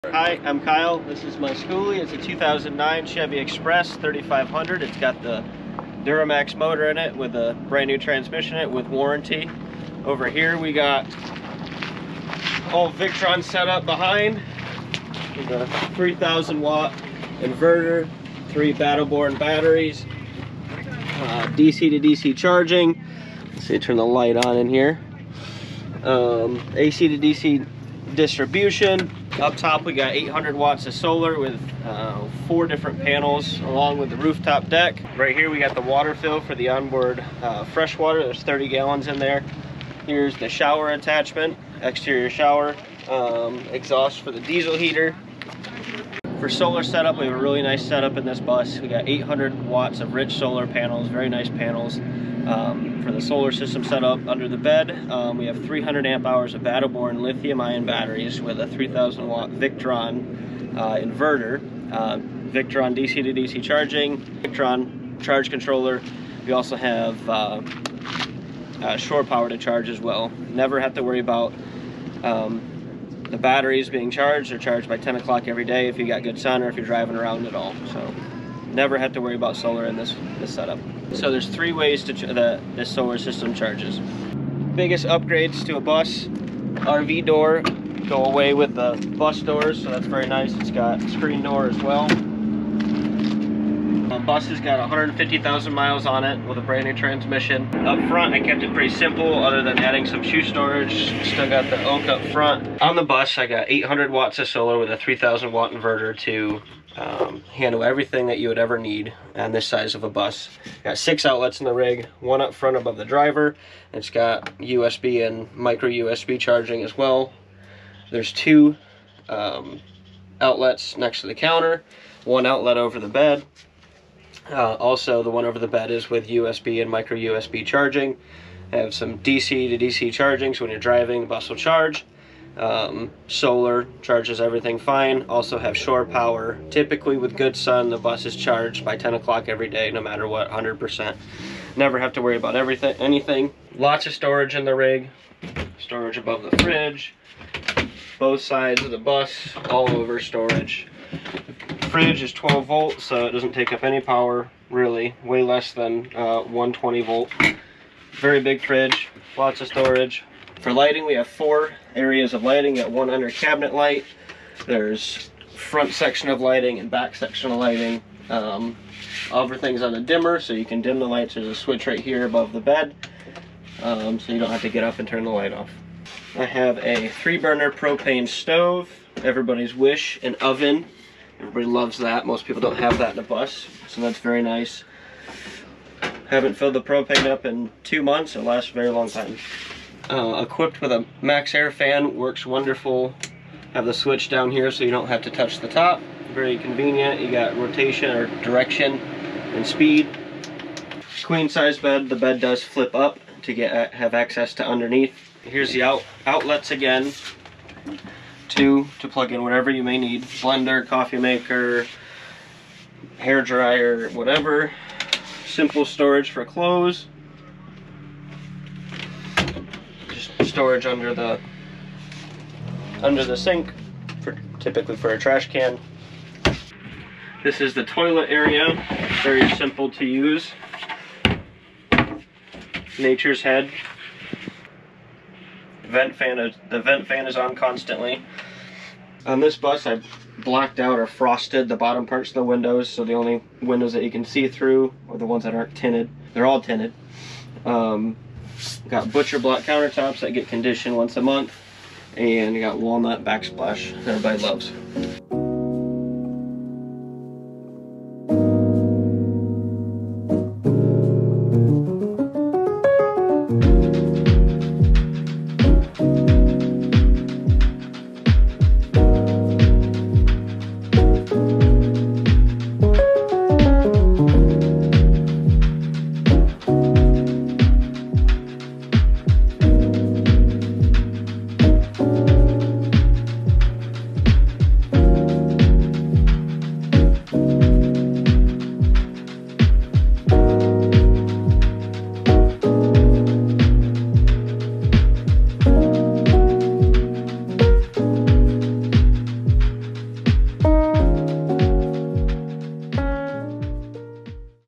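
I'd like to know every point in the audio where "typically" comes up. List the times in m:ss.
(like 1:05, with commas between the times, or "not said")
2:16, 3:44.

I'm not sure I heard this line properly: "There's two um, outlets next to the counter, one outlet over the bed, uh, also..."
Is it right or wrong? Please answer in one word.
right.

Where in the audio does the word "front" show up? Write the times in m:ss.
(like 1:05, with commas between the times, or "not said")
1:38, 1:42, 1:52, 2:45.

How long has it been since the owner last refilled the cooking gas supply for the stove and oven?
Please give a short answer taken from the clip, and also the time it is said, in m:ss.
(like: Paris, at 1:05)
2 months, at 3:07.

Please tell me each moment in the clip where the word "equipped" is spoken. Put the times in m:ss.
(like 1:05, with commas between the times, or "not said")
3:10.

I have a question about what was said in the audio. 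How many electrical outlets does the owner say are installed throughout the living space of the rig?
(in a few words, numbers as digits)
6.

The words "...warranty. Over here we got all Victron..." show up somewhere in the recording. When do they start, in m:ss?
0:08.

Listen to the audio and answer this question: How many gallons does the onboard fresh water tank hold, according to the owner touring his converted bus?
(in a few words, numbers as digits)
30.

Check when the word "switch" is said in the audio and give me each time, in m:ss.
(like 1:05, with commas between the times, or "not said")
2:51, 3:13.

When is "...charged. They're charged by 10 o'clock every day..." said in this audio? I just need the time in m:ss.
1:14.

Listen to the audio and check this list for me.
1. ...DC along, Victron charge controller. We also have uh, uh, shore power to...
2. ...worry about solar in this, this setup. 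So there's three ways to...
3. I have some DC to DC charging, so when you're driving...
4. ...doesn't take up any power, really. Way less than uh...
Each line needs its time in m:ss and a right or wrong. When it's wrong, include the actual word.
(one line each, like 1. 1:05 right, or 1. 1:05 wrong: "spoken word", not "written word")
1. 1:03 wrong: "charging", not "along"
2. 1:19 right
3. 2:08 right
4. 2:33 right.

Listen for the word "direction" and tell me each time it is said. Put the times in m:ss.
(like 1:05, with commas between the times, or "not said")
3:18.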